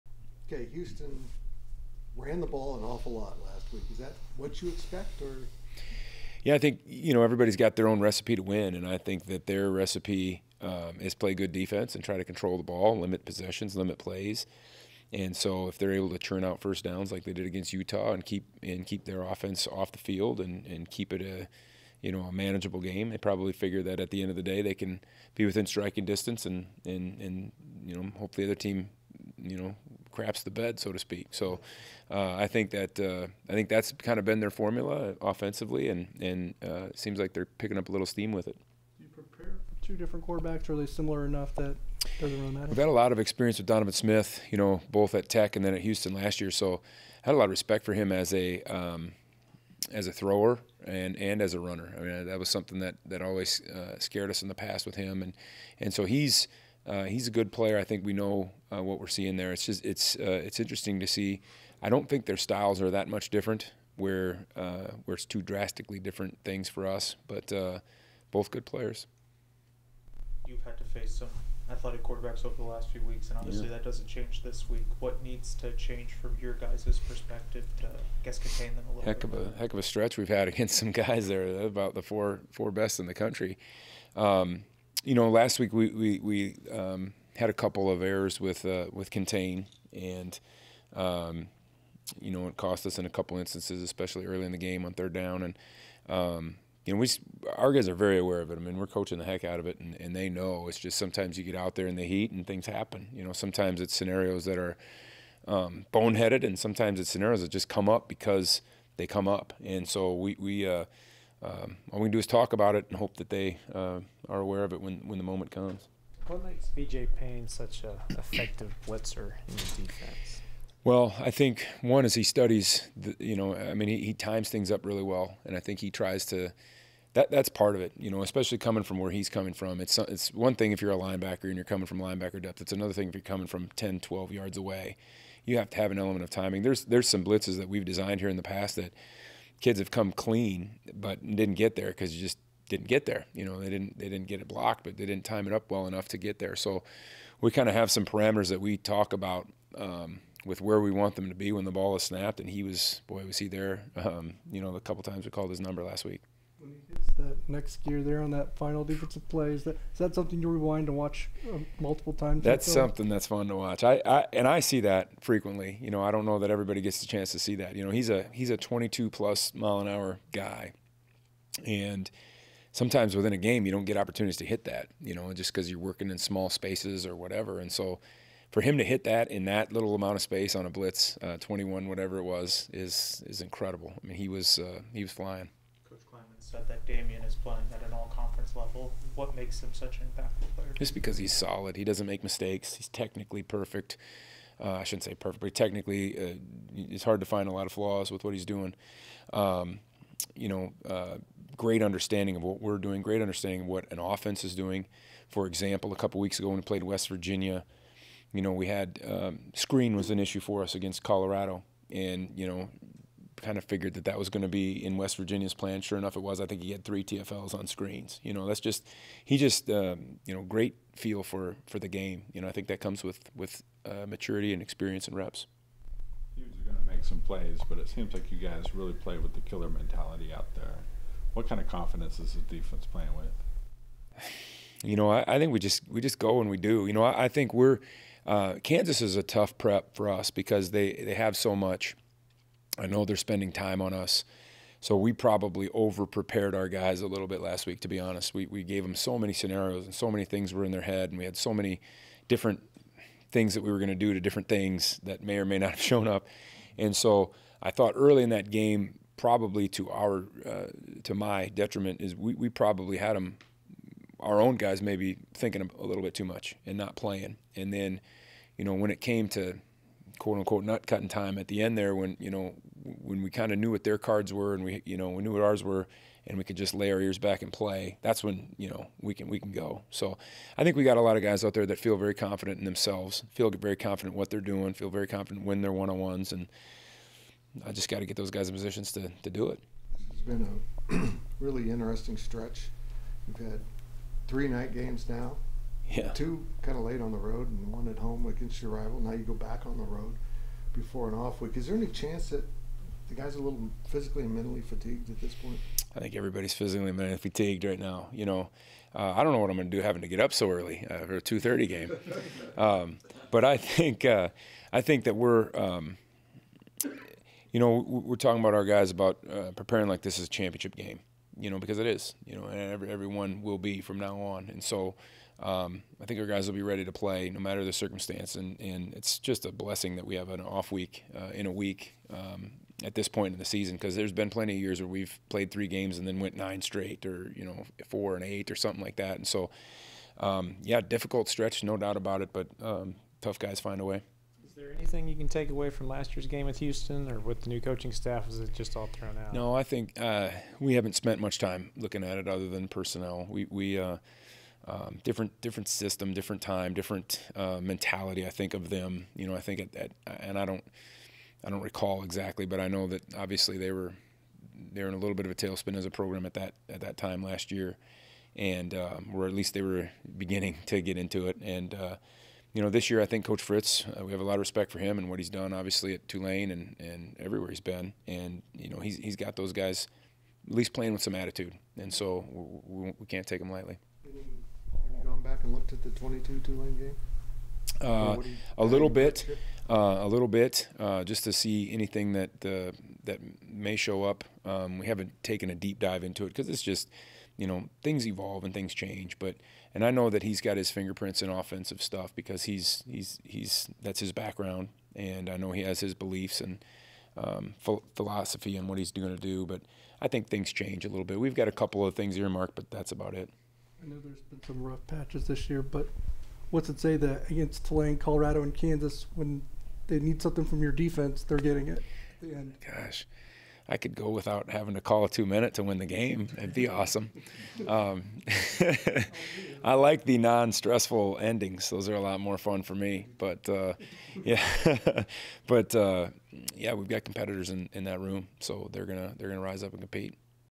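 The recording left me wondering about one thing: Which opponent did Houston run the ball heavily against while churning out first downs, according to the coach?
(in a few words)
Utah.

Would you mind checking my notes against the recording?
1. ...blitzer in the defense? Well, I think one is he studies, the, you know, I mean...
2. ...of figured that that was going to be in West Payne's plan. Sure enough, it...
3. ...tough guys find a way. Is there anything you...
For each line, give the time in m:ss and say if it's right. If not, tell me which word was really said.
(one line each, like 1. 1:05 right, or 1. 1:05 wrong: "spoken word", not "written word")
1. 1:58 right
2. 3:33 wrong: "Virginia", not "Payne"
3. 5:43 right.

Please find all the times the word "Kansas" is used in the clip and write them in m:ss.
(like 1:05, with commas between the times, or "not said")
3:58, 6:58.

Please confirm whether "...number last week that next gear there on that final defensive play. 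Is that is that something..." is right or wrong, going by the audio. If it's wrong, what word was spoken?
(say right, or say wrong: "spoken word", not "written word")
right.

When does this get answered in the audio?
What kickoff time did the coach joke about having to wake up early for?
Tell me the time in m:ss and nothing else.
5:11.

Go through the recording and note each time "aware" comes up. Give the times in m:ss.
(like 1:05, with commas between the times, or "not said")
1:38, 1:54.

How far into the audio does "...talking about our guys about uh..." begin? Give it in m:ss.
5:18.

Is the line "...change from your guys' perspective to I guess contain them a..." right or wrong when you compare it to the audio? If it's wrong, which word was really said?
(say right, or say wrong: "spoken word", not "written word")
right.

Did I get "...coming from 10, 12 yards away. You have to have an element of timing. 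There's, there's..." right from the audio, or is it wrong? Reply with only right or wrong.
right.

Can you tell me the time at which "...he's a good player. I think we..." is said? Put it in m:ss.
0:57.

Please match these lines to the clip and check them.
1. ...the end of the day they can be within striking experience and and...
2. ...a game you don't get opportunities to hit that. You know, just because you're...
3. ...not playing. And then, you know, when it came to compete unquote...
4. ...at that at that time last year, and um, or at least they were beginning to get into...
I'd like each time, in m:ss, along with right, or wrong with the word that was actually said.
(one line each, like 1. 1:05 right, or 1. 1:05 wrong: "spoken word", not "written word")
1. 0:24 wrong: "distance", not "experience"
2. 2:53 right
3. 4:26 wrong: "quote", not "compete"
4. 6:06 right.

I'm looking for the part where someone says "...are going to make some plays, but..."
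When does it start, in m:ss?
3:46.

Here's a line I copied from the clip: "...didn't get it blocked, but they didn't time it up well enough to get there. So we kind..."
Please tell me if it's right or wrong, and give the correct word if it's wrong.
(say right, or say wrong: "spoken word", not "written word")
right.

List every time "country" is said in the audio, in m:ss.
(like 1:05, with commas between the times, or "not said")
1:23.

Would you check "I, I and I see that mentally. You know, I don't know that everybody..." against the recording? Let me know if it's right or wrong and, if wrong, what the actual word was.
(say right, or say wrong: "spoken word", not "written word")
wrong: "frequently", not "mentally".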